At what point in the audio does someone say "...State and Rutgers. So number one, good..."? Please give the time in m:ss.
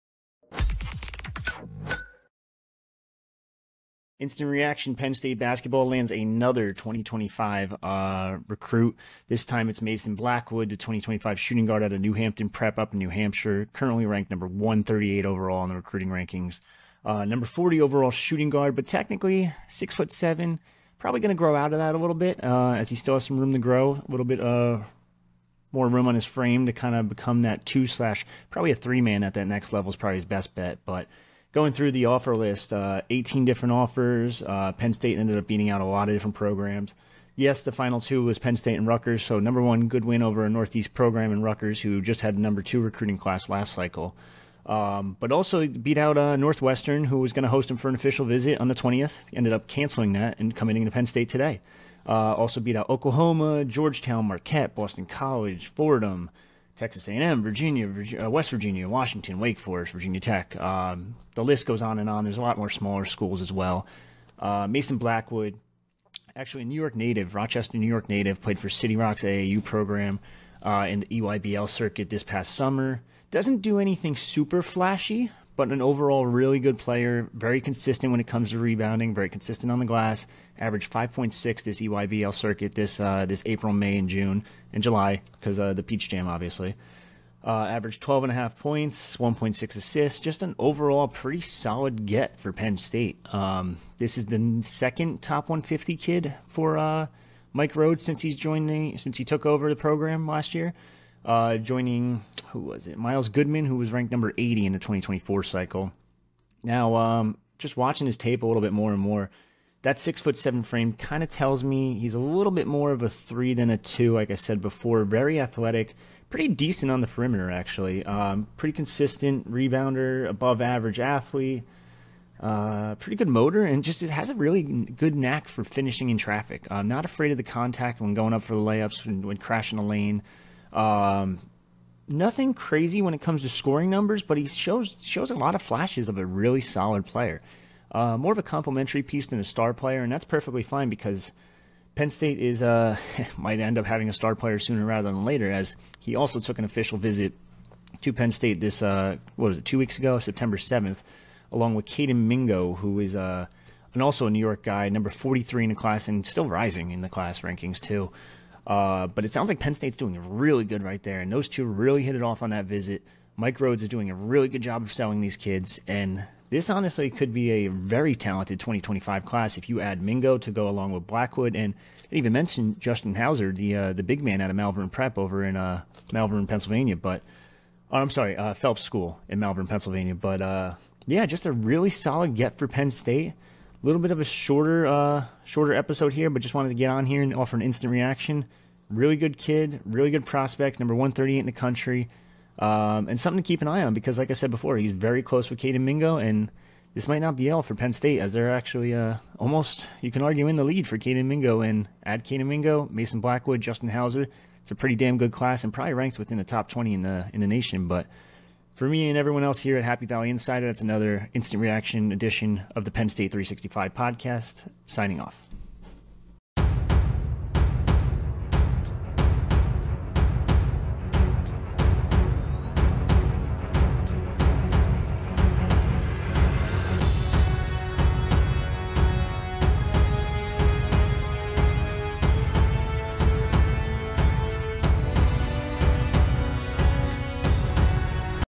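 0:38.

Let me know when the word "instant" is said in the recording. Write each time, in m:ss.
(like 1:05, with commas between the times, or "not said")
0:04, 3:07, 3:31.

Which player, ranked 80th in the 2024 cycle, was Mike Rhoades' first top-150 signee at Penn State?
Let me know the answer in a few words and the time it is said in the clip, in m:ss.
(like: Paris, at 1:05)
Miles Goodman, at 1:42.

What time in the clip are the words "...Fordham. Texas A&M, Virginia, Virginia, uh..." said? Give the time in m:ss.
0:55.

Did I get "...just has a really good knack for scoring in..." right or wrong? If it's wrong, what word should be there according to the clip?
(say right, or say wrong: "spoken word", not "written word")
wrong: "finishing", not "scoring".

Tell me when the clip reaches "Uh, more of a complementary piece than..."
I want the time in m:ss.
2:17.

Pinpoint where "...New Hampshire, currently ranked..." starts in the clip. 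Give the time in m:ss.
0:12.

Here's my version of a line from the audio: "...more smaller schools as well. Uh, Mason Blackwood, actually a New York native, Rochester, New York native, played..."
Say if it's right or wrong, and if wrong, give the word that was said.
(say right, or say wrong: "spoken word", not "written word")
right.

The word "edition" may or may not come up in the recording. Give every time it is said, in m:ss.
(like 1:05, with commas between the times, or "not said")
3:32.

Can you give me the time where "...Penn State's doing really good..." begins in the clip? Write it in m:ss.
2:39.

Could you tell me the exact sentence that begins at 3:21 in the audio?
And add Kayden Mingo, Mason Blackwood, Justin Hauser.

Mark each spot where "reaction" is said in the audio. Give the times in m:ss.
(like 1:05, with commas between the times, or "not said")
0:04, 3:07, 3:31.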